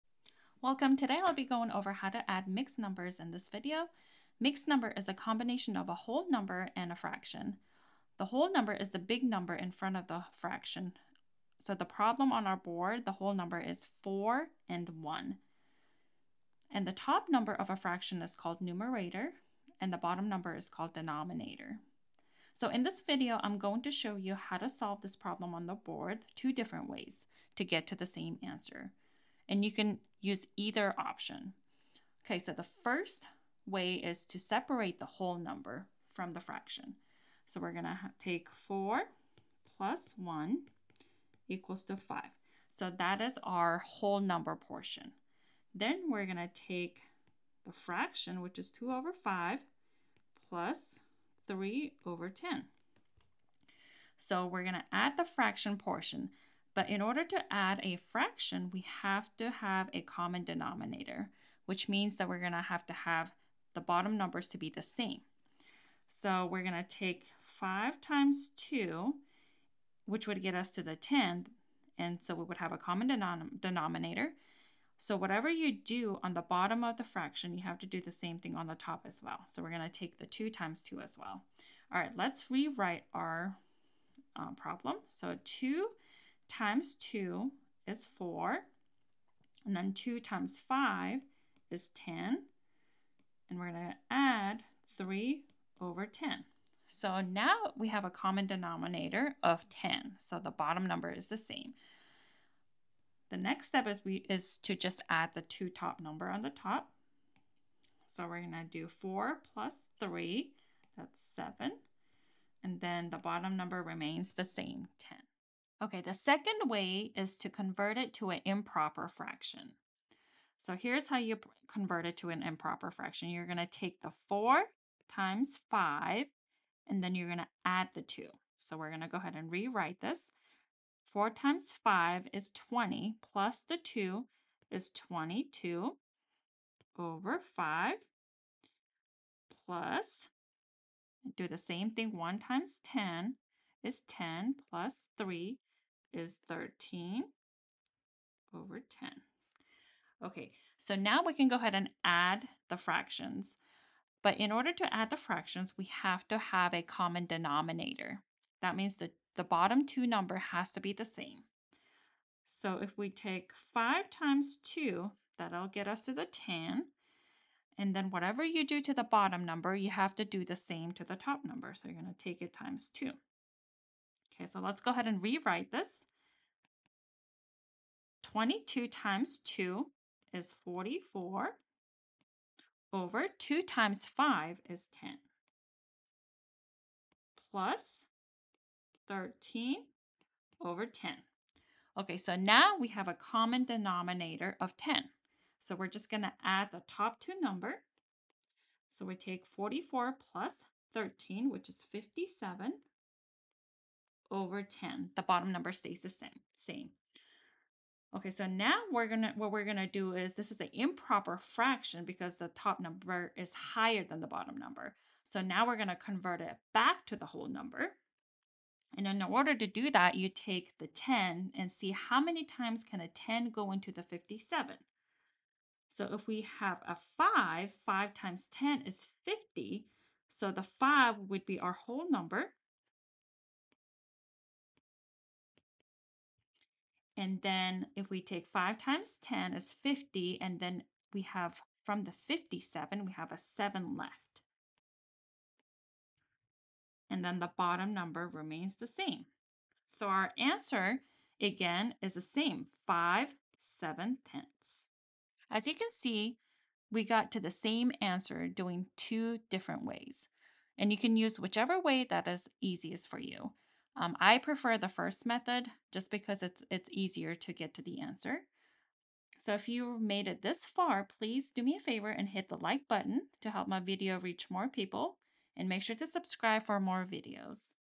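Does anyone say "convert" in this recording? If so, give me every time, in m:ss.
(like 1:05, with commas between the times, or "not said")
1:57, 2:01, 3:35.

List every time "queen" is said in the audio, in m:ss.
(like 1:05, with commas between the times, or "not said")
not said.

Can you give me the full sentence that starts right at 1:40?
So the bottom number is the same.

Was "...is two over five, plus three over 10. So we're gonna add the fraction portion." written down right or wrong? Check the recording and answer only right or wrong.
right.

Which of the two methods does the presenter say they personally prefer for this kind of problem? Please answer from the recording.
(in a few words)
the first method.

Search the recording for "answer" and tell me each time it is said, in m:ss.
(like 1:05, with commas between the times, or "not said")
0:28, 4:10, 4:18, 4:28.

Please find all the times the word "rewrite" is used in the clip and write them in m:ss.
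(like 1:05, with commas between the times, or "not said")
1:22, 2:09, 2:55.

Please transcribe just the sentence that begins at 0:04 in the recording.
Mixed number is a combination of a whole number and a fraction.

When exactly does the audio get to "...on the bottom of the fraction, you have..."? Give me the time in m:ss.
1:16.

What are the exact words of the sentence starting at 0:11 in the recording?
So the problem on our board, the whole number is 4 and 1.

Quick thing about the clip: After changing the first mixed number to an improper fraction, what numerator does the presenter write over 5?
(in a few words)
22.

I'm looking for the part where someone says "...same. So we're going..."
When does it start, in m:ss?
1:04.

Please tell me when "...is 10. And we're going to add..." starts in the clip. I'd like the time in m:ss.
1:31.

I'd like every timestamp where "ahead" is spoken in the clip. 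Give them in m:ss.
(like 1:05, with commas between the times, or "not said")
2:09, 2:31, 2:54.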